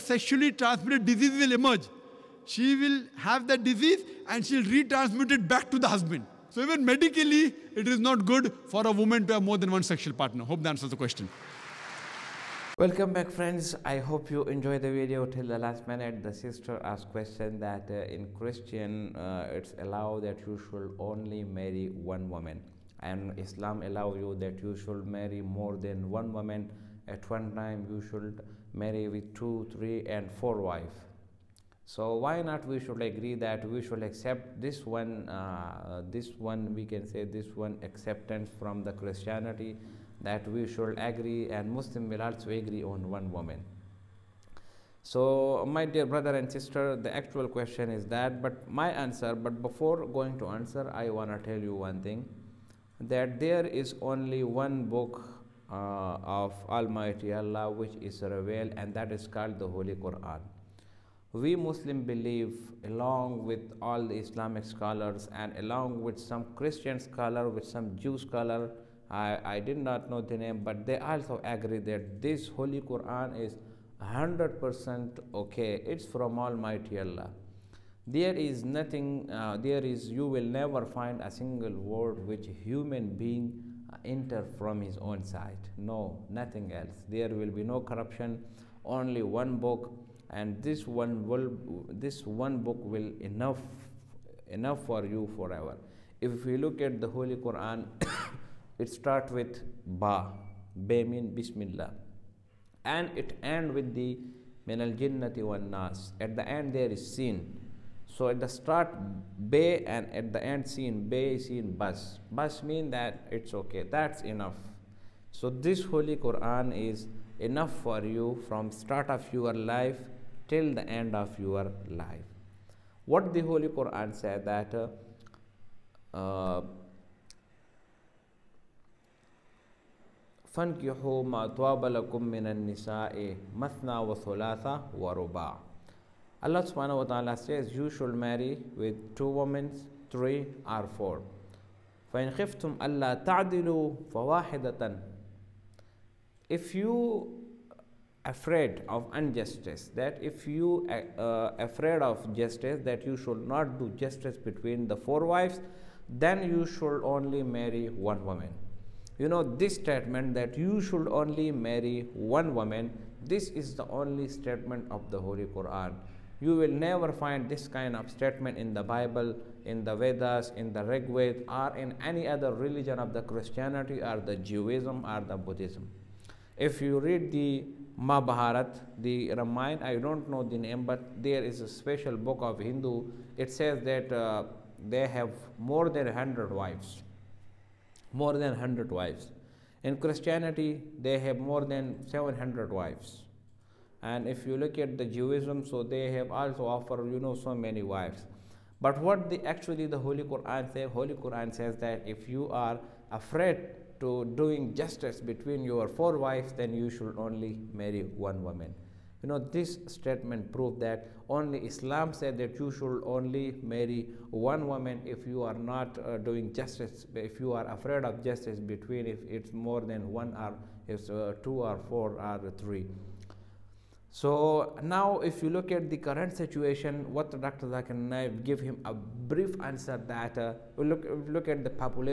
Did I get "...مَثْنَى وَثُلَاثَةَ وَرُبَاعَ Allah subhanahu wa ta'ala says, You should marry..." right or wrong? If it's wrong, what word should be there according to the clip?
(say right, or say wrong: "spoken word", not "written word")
right.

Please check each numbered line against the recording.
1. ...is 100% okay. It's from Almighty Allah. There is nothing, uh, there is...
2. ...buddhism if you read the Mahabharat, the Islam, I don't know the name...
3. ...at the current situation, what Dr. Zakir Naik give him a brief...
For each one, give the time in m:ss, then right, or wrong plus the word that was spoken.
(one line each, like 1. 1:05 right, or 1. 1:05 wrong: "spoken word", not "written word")
1. 1:13 right
2. 2:55 wrong: "Ramayana", not "Islam"
3. 3:45 right.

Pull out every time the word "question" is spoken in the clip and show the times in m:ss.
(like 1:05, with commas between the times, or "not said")
0:10, 0:17, 0:47.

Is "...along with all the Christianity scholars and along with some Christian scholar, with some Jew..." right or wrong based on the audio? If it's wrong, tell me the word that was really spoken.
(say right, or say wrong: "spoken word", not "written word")
wrong: "Islamic", not "Christianity".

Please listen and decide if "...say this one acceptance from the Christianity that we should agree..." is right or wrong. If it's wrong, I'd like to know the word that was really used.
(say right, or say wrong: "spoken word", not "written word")
right.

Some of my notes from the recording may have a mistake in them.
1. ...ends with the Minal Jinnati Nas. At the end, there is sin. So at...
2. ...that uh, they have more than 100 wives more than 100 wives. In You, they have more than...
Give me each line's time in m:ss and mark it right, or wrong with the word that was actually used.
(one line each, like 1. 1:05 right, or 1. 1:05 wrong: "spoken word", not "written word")
1. 1:43 right
2. 3:03 wrong: "Christianity", not "You".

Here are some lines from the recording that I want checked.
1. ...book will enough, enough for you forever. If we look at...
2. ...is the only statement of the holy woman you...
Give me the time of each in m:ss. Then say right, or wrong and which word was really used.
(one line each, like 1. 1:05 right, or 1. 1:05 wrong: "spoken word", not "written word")
1. 1:32 right
2. 2:43 wrong: "quran", not "woman".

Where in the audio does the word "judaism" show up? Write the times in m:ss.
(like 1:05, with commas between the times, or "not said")
2:54, 3:15.